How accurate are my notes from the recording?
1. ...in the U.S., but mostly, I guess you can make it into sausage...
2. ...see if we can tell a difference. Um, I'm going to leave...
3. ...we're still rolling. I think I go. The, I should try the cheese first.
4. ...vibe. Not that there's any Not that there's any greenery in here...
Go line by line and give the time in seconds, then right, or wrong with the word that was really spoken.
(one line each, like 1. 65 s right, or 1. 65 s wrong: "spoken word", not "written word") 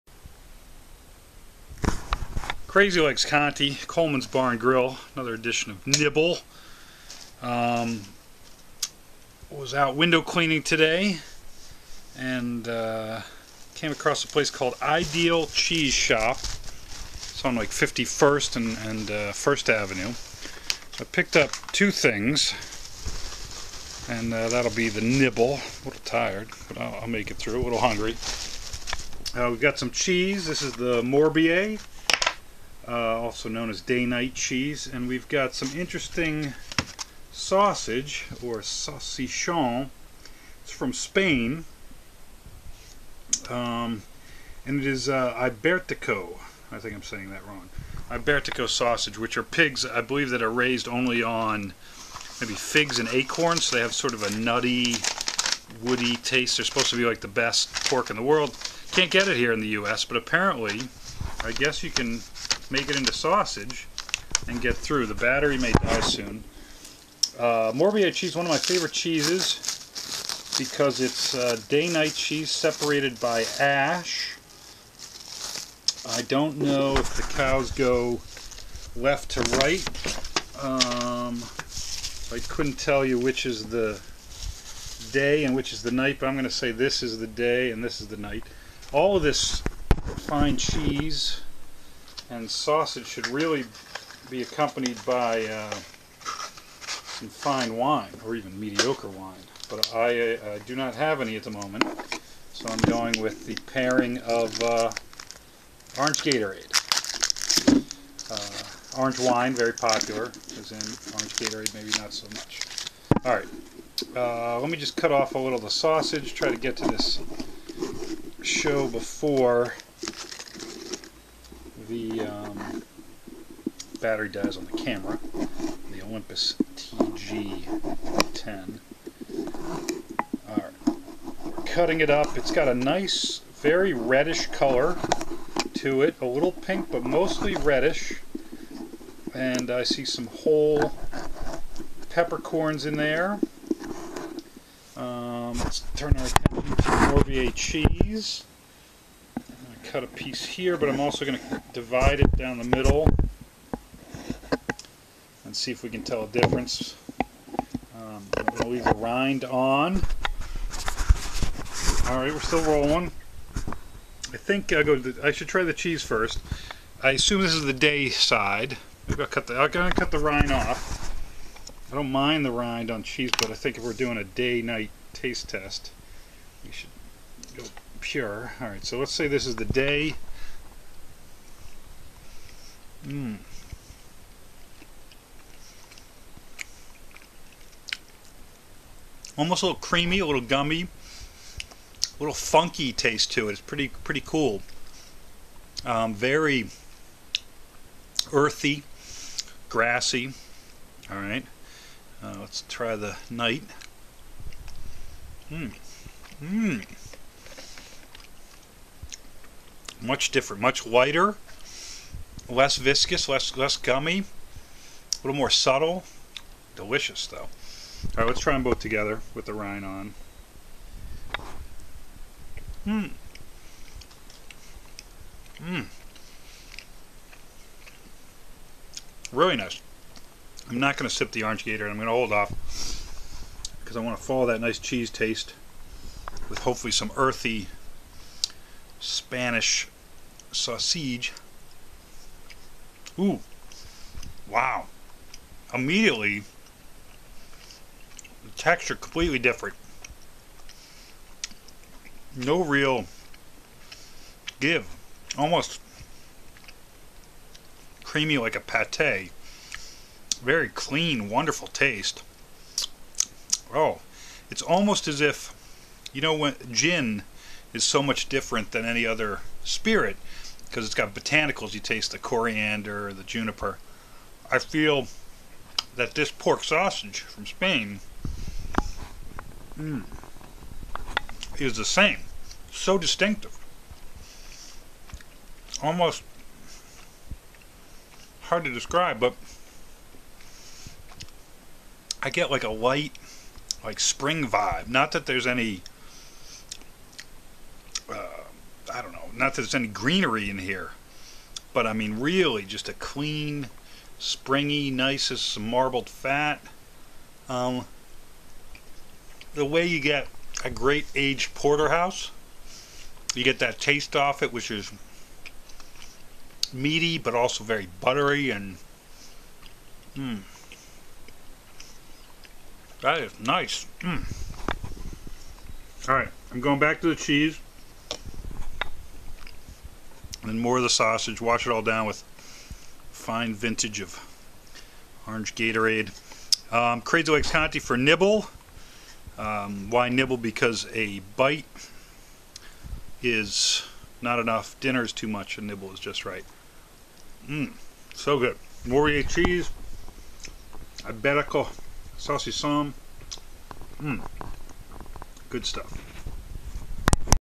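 1. 59 s wrong: "apparently", not "mostly"
2. 155 s right
3. 162 s right
4. 294 s right.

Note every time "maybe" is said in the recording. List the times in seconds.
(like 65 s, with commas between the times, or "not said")
52 s, 111 s, 169 s.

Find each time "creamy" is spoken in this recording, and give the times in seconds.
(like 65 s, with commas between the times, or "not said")
189 s, 258 s.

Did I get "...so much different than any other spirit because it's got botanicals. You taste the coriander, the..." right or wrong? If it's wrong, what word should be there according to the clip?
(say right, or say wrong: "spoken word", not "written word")
right.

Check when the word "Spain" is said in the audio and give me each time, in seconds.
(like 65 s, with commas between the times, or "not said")
40 s, 277 s.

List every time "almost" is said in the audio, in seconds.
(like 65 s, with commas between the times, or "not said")
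189 s, 255 s, 264 s, 285 s.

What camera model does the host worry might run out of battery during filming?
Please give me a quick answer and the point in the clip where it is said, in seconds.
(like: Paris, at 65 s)
Olympus TG10, at 126 s.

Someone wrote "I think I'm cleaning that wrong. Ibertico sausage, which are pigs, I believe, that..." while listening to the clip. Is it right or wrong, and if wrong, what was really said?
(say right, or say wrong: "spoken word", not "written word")
wrong: "saying", not "cleaning".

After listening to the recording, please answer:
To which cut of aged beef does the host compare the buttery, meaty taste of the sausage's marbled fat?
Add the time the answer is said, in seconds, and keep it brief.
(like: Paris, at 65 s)
Porterhouse, at 311 s.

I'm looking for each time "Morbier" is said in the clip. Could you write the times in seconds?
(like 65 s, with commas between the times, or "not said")
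31 s, 67 s, 147 s, 348 s.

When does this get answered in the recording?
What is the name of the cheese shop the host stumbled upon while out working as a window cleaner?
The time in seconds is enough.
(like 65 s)
14 s.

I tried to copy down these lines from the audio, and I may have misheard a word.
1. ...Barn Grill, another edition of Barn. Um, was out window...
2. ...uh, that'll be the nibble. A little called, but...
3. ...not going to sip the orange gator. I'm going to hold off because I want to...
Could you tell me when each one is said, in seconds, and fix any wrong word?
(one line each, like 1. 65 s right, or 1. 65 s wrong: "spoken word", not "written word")
1. 4 s wrong: "Nibble", not "Barn"
2. 24 s wrong: "tired", not "called"
3. 230 s right.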